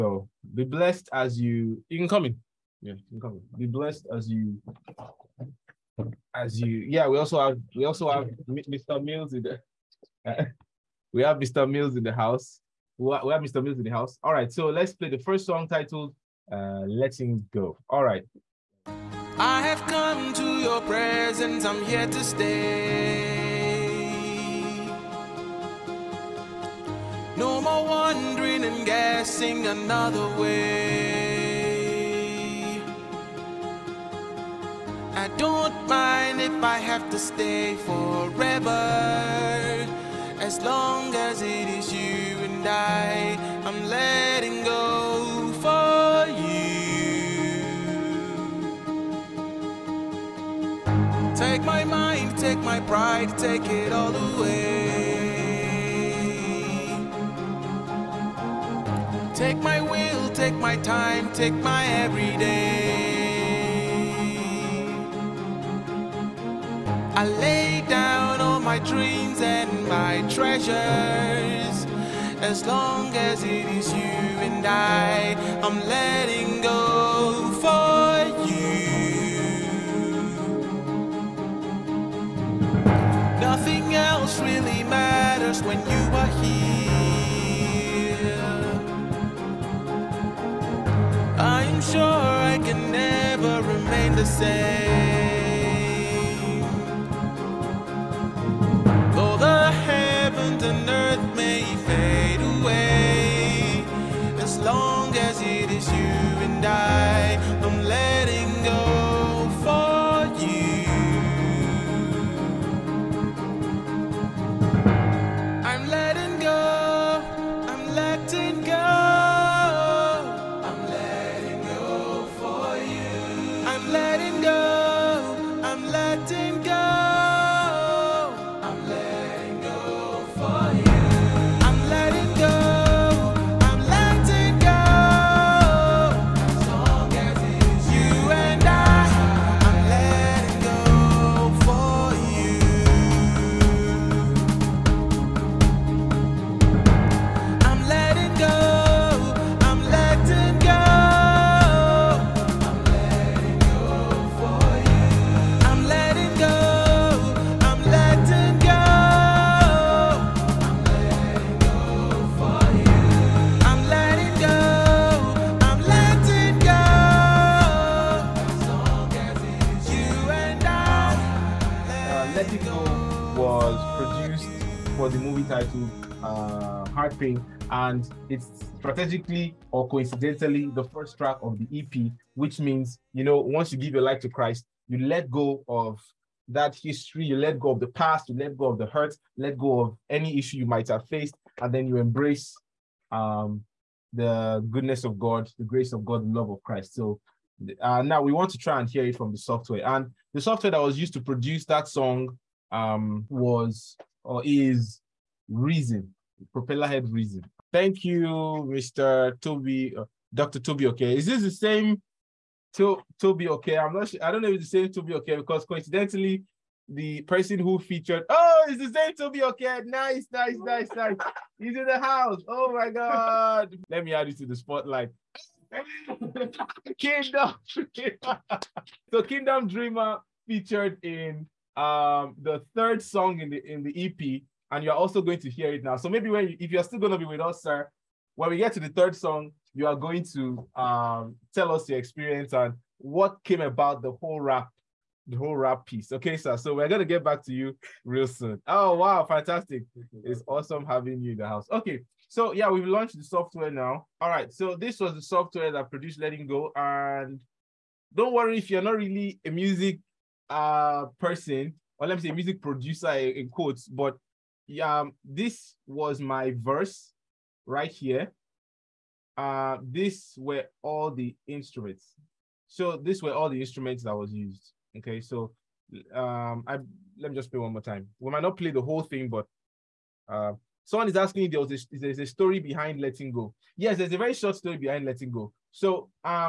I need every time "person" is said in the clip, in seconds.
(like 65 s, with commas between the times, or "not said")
217 s, 261 s.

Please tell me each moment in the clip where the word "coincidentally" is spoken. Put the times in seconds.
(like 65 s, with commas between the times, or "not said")
179 s, 215 s.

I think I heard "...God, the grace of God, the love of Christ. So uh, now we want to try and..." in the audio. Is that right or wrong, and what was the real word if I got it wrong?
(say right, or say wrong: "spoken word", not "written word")
right.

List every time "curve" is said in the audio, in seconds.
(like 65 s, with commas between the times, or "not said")
not said.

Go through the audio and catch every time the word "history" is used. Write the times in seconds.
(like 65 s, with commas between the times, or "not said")
186 s.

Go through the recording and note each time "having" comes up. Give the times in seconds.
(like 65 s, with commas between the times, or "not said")
250 s.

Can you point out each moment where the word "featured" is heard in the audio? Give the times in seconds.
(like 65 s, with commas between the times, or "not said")
217 s, 230 s.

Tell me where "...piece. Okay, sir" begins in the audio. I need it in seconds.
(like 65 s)
245 s.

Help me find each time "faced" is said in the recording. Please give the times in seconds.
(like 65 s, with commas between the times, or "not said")
191 s.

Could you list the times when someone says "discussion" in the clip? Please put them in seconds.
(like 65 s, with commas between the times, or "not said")
not said.